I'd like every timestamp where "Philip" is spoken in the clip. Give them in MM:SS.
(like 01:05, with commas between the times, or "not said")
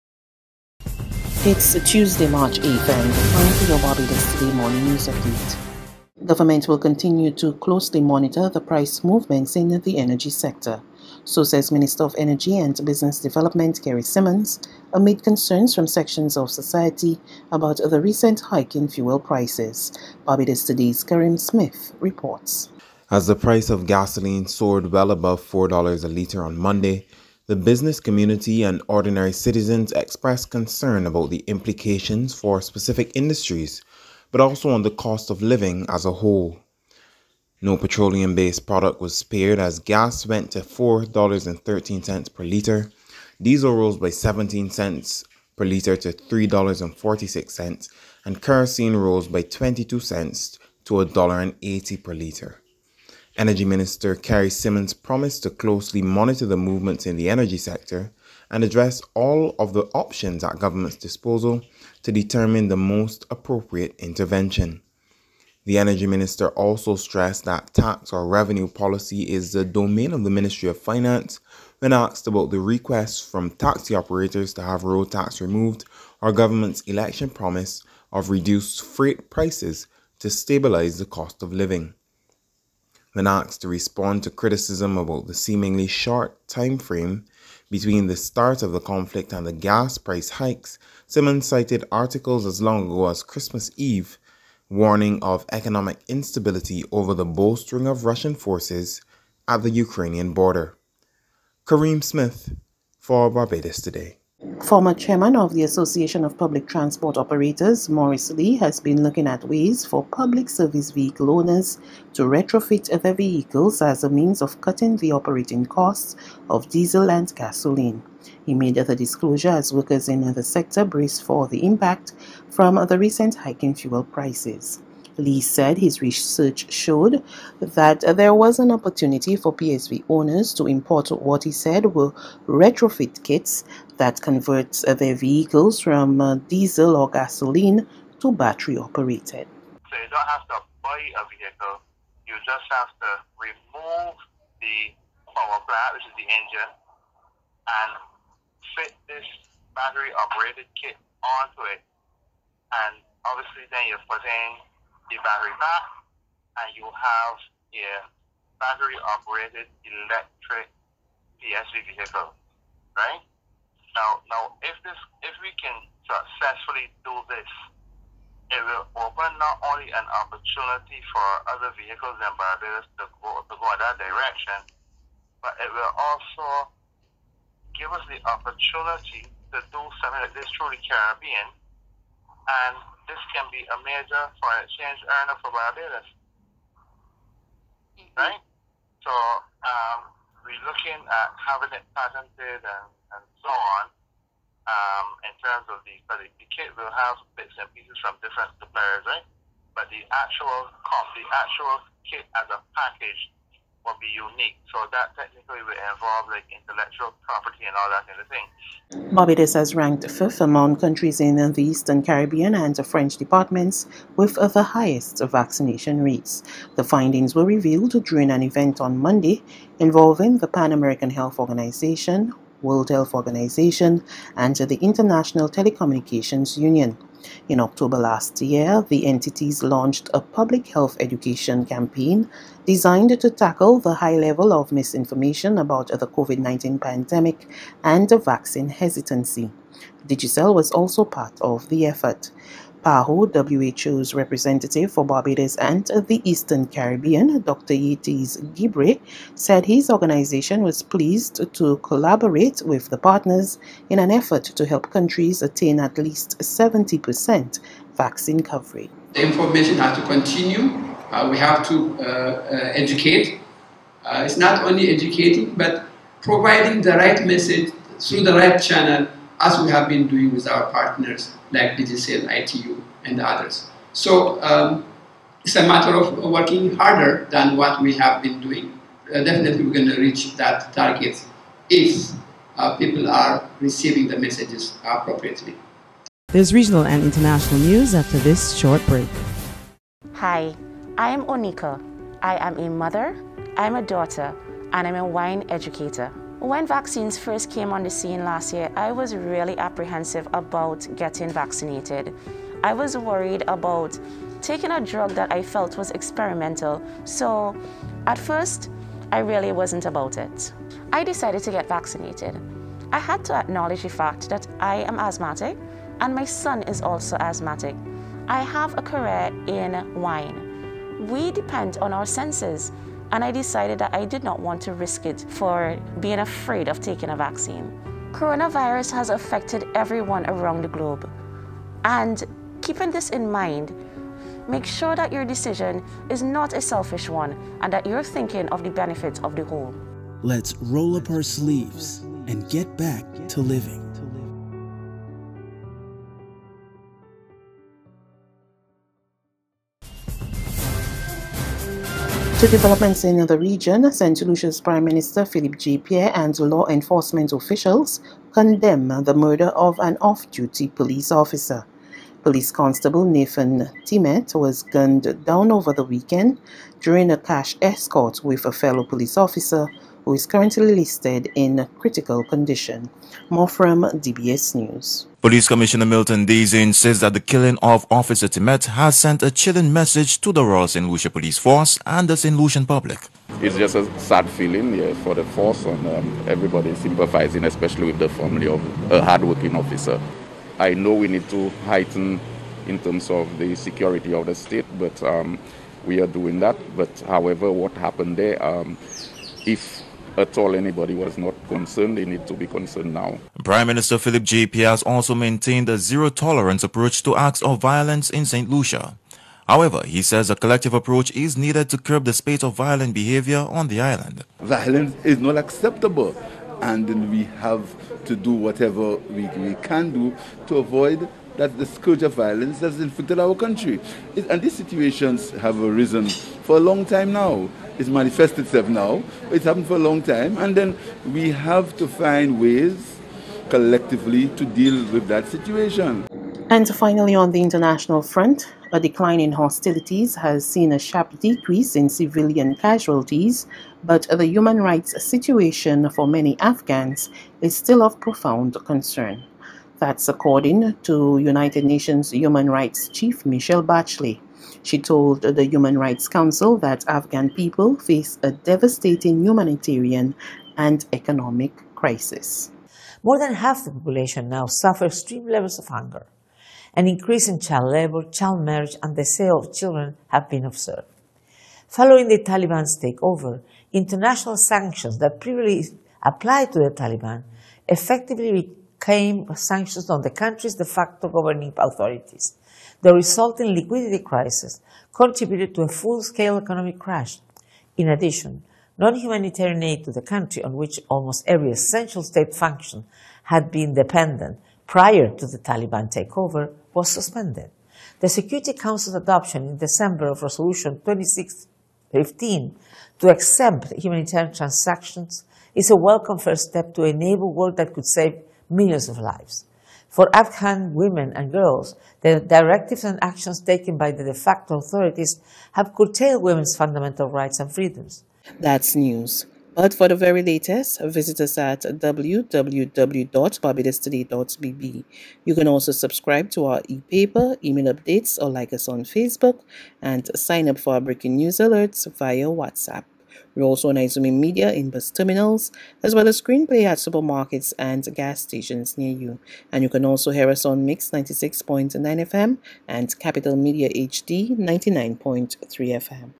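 05:55, 06:43.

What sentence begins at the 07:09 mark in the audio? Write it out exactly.
It's happened for a long time.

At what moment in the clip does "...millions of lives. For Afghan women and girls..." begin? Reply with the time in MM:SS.
08:28.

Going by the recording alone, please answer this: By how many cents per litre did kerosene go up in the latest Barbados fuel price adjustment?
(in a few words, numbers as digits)
22 cents.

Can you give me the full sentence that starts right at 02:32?
And obviously, then you're putting the battery pack, and you have a battery operated electric PSV vehicle, right?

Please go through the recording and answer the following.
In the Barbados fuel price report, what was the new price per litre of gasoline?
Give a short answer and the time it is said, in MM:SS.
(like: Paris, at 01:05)
$4.13, at 00:40.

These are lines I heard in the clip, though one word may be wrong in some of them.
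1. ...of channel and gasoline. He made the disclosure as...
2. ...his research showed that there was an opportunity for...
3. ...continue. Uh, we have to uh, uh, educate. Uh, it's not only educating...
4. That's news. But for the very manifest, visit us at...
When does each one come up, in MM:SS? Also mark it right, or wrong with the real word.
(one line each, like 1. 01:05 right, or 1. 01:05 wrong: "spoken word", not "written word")
1. 01:56 wrong: "diesel", not "channel"
2. 02:05 right
3. 04:20 right
4. 08:38 wrong: "latest", not "manifest".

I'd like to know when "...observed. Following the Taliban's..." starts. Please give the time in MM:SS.
07:50.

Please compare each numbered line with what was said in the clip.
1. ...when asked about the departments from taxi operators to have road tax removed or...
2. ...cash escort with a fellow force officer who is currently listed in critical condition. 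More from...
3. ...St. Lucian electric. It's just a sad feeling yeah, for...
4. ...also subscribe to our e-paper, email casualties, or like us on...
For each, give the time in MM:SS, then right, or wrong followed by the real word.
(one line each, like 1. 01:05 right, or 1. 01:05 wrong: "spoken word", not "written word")
1. 01:11 wrong: "requests", not "departments"
2. 06:07 wrong: "police", not "force"
3. 06:22 wrong: "public", not "electric"
4. 08:45 wrong: "updates", not "casualties".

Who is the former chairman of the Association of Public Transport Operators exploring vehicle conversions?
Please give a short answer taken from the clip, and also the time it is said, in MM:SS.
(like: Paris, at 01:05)
Morris Lee, at 01:47.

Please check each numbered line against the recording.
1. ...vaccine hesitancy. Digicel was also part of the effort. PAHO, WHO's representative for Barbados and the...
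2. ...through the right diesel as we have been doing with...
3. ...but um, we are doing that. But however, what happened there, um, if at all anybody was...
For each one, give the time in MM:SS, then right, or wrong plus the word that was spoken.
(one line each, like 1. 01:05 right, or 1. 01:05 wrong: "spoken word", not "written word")
1. 03:58 right
2. 04:27 wrong: "channel", not "diesel"
3. 06:34 right.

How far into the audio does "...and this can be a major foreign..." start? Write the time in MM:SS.
03:01.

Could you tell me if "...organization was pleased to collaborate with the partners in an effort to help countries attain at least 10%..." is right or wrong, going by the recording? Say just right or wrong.
wrong.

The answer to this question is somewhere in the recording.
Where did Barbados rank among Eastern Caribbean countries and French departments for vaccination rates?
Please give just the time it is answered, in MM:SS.
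03:30.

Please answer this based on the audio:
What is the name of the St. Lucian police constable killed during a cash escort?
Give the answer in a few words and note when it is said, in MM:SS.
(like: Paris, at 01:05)
Nathan Timet, at 06:03.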